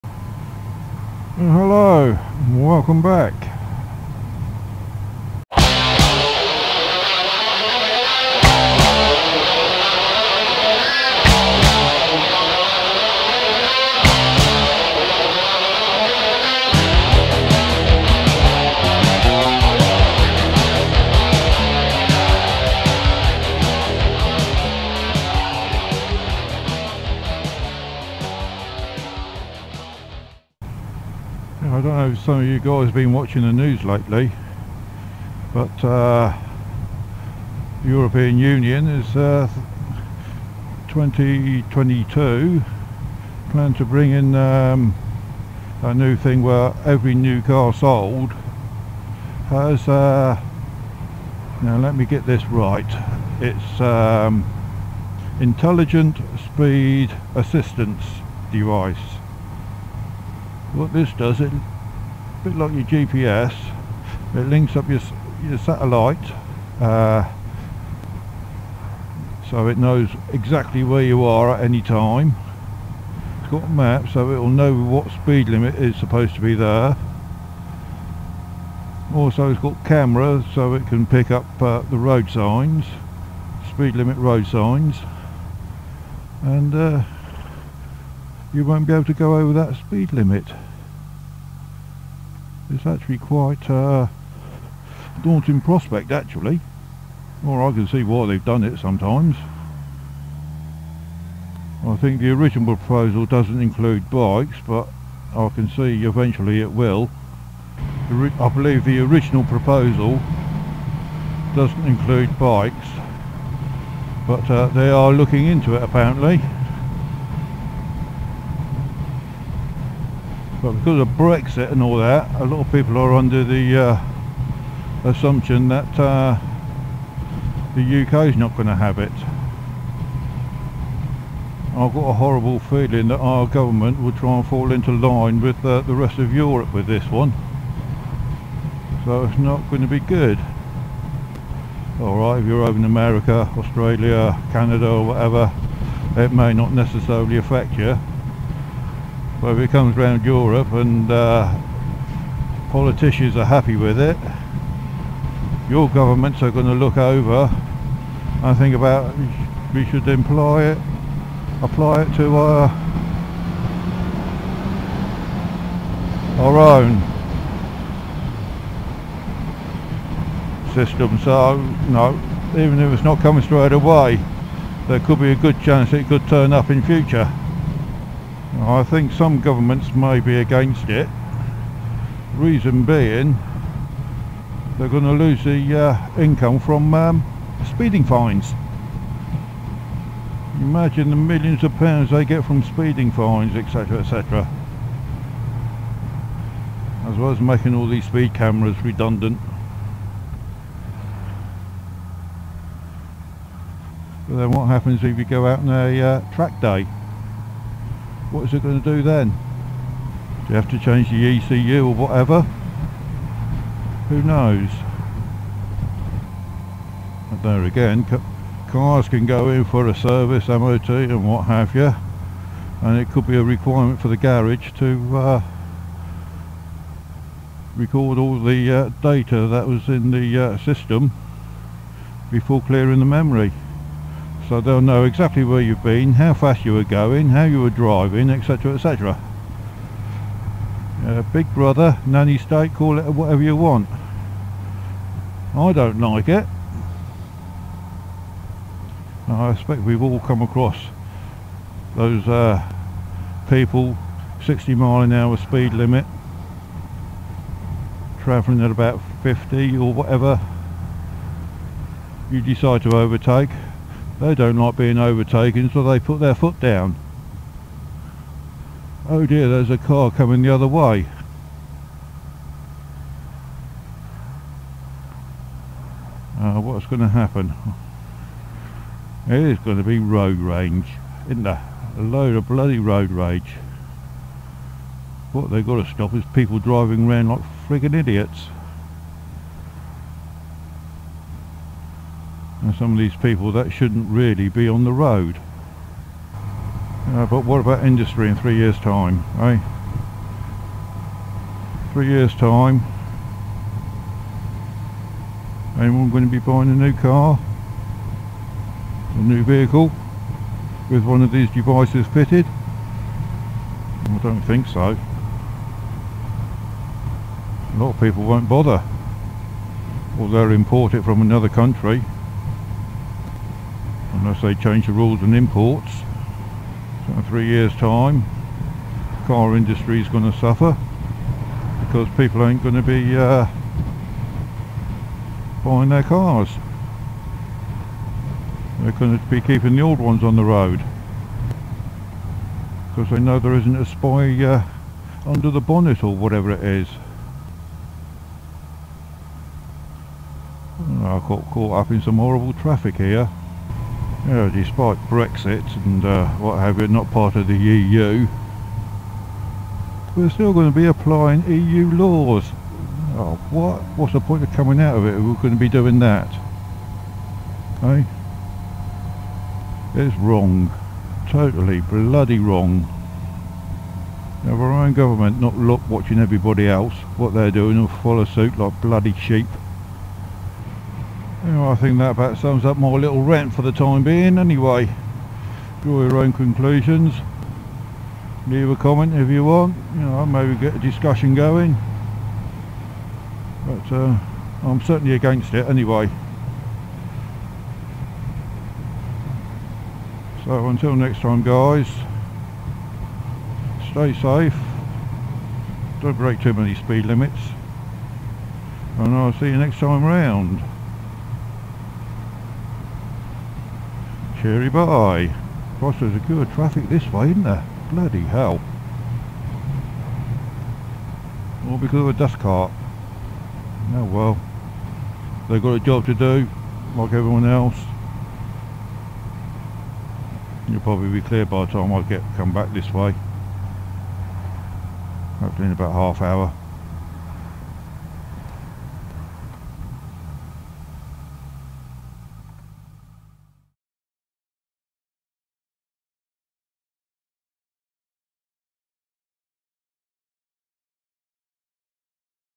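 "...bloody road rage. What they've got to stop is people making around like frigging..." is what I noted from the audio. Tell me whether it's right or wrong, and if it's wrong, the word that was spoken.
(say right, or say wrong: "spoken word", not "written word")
wrong: "driving", not "making".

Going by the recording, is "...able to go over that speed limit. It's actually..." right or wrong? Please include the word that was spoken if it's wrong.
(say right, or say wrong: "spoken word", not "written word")
right.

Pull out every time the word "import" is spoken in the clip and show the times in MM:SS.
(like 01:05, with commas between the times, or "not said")
05:20, 05:25.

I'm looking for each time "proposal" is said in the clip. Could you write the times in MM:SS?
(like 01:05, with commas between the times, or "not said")
01:42, 01:49.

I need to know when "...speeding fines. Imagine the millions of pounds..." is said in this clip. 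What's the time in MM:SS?
03:07.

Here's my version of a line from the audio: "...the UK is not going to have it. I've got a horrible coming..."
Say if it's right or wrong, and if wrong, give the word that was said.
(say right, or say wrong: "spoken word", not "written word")
wrong: "feeling", not "coming".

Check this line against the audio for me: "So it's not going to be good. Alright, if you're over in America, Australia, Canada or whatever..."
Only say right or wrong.
right.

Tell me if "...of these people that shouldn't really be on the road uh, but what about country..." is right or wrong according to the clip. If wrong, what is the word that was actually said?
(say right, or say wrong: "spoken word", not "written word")
wrong: "industry", not "country".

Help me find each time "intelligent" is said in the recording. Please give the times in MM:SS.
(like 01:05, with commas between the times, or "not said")
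00:55.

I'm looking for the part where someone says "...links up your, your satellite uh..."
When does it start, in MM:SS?
01:04.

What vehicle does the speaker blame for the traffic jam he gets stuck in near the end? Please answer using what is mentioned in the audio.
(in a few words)
Dust cart.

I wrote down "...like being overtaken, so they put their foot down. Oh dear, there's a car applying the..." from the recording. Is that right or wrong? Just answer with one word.
wrong.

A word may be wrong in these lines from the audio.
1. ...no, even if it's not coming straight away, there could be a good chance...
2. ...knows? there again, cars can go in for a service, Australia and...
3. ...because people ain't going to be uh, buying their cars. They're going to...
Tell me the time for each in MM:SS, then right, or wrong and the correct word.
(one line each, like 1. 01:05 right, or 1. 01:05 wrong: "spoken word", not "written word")
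1. 02:51 right
2. 03:34 wrong: "MOT", not "Australia"
3. 05:31 right.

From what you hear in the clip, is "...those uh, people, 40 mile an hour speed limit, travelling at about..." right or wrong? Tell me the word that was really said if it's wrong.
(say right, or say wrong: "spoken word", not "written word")
wrong: "60", not "40".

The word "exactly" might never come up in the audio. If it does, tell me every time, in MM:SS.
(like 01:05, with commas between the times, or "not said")
01:10, 03:55.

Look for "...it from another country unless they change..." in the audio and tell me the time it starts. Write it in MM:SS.
05:20.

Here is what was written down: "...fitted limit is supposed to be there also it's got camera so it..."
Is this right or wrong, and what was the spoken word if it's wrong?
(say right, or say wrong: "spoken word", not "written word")
wrong: "speed", not "fitted".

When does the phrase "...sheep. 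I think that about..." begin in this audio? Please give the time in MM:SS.
06:19.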